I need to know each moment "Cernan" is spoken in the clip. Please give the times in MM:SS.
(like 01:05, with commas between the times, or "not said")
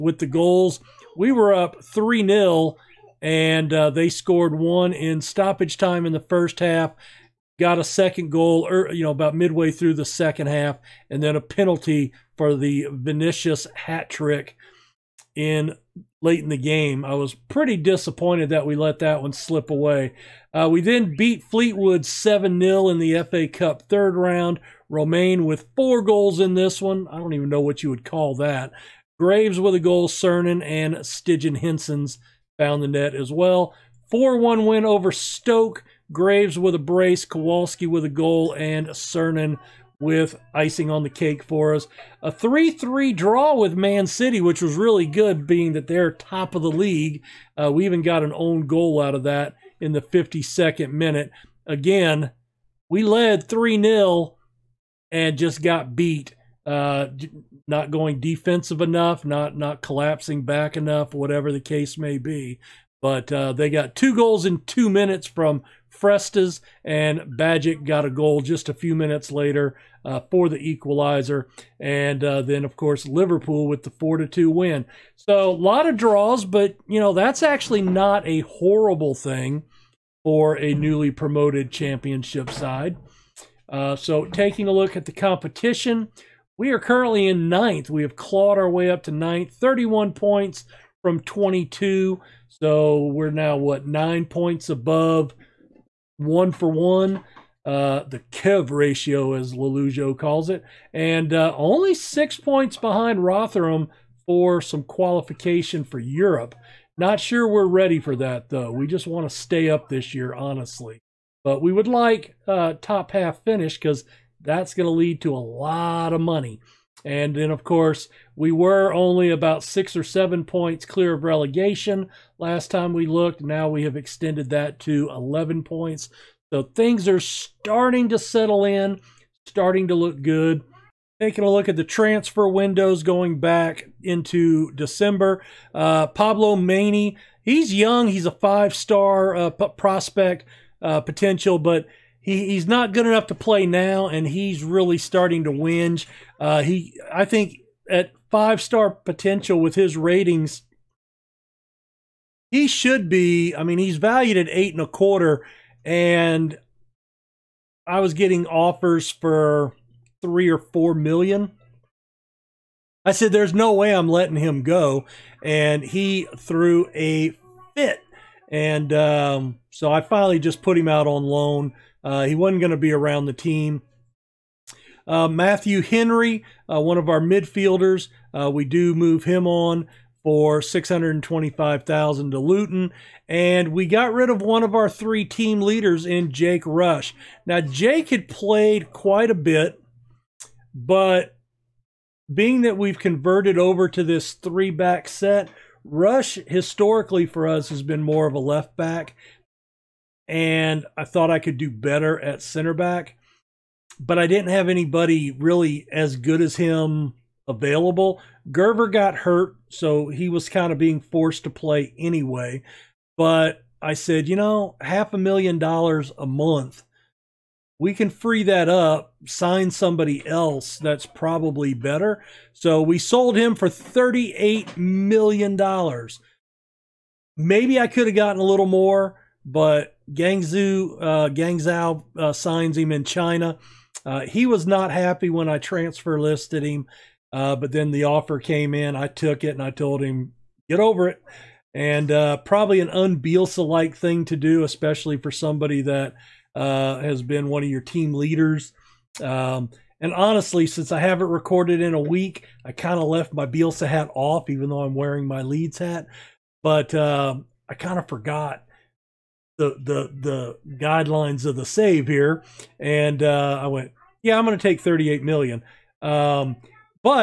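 00:30, 00:38.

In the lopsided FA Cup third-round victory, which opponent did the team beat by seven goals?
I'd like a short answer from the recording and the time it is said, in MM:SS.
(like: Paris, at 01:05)
Fleetwood, at 00:21.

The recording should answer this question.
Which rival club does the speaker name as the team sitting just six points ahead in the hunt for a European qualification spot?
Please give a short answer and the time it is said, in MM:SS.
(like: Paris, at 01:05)
Rotherham, at 01:43.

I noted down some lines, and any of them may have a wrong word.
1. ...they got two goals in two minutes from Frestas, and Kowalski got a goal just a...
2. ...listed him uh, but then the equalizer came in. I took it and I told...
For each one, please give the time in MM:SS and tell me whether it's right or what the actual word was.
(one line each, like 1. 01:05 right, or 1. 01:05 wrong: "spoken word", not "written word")
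1. 01:03 wrong: "Bajic", not "Kowalski"
2. 03:56 wrong: "offer", not "equalizer".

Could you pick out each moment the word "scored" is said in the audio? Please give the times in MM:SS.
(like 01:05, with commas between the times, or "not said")
00:04.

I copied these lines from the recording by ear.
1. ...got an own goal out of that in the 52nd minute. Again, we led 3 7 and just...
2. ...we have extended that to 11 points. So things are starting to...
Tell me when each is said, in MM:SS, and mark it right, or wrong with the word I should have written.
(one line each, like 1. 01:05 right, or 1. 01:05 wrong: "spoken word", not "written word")
1. 00:48 wrong: "0", not "7"
2. 02:03 right.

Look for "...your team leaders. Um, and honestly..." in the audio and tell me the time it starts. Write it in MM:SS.
04:07.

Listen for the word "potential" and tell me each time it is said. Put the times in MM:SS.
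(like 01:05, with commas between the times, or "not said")
02:21, 02:28.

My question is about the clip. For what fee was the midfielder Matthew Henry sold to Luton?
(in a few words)
625,000.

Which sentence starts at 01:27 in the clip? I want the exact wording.
We have clawed our way up to ninth, 31 points from 22.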